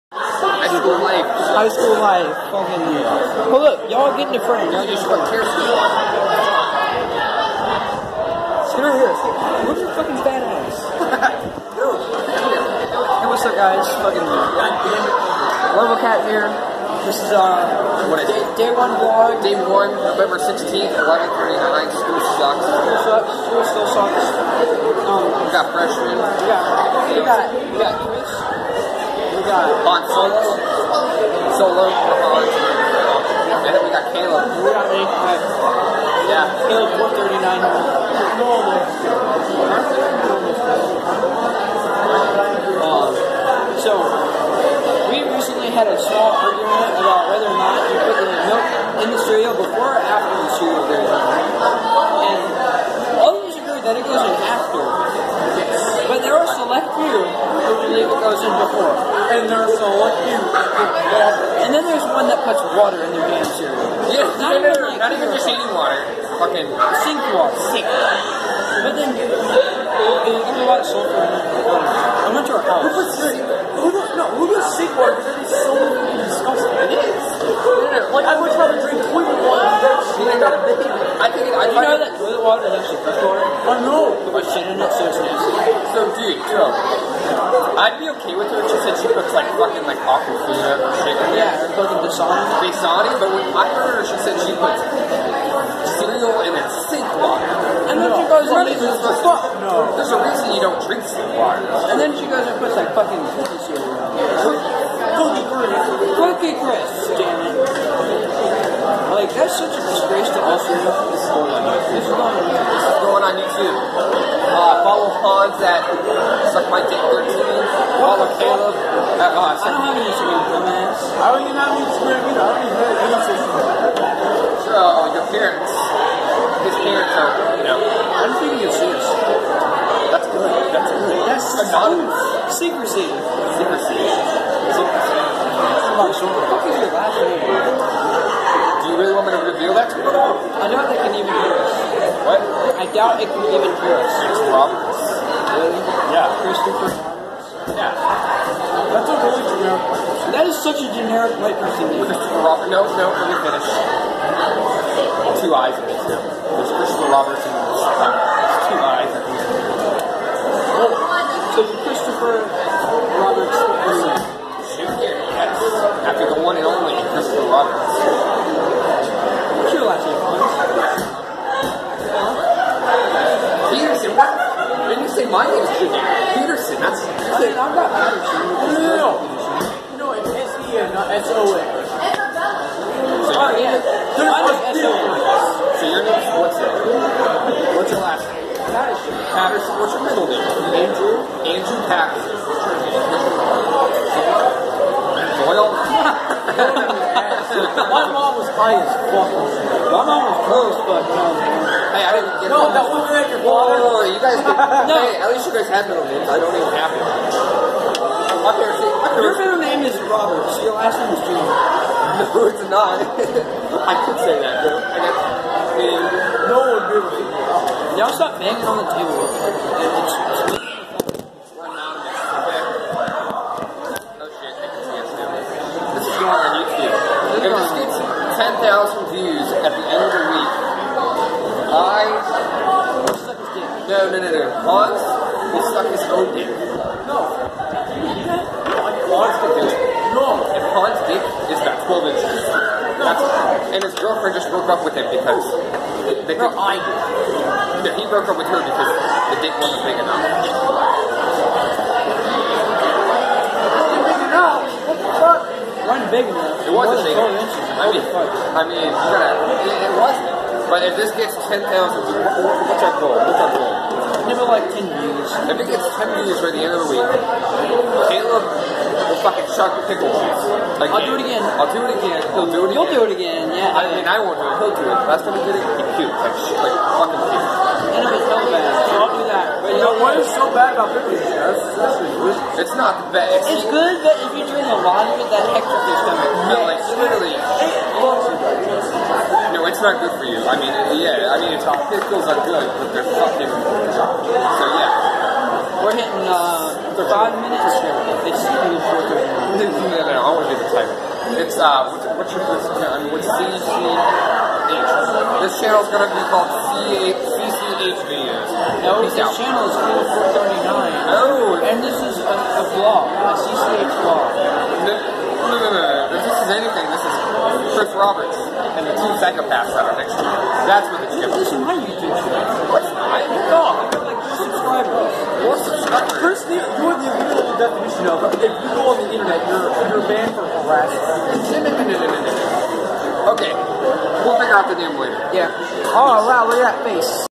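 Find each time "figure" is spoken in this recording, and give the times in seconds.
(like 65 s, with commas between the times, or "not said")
334 s.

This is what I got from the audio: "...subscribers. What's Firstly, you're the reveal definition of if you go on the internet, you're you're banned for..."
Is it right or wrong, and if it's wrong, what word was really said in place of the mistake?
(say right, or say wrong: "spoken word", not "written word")
wrong: "literal", not "reveal".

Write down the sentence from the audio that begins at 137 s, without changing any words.
Do you really want me to reveal that to you?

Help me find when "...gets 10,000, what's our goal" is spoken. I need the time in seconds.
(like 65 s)
261 s.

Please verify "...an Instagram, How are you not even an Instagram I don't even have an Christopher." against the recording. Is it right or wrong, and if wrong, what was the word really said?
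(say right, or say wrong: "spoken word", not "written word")
wrong: "Instagram", not "Christopher".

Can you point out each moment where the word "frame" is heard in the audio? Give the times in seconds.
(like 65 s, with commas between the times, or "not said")
4 s.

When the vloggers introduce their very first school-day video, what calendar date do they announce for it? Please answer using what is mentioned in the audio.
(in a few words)
November 16th.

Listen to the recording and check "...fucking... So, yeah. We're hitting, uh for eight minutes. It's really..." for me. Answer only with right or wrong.
wrong.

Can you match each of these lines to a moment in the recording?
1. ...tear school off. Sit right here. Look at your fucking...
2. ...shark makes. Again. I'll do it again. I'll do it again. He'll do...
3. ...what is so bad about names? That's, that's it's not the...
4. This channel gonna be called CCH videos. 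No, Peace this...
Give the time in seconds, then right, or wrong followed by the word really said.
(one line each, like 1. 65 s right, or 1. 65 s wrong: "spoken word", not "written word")
1. 5 s right
2. 269 s wrong: "pickles", not "makes"
3. 280 s wrong: "pickles", not "names"
4. 303 s right.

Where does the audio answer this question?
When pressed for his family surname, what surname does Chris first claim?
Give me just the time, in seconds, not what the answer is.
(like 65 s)
144 s.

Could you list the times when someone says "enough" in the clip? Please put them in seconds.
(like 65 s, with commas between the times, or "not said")
249 s, 257 s.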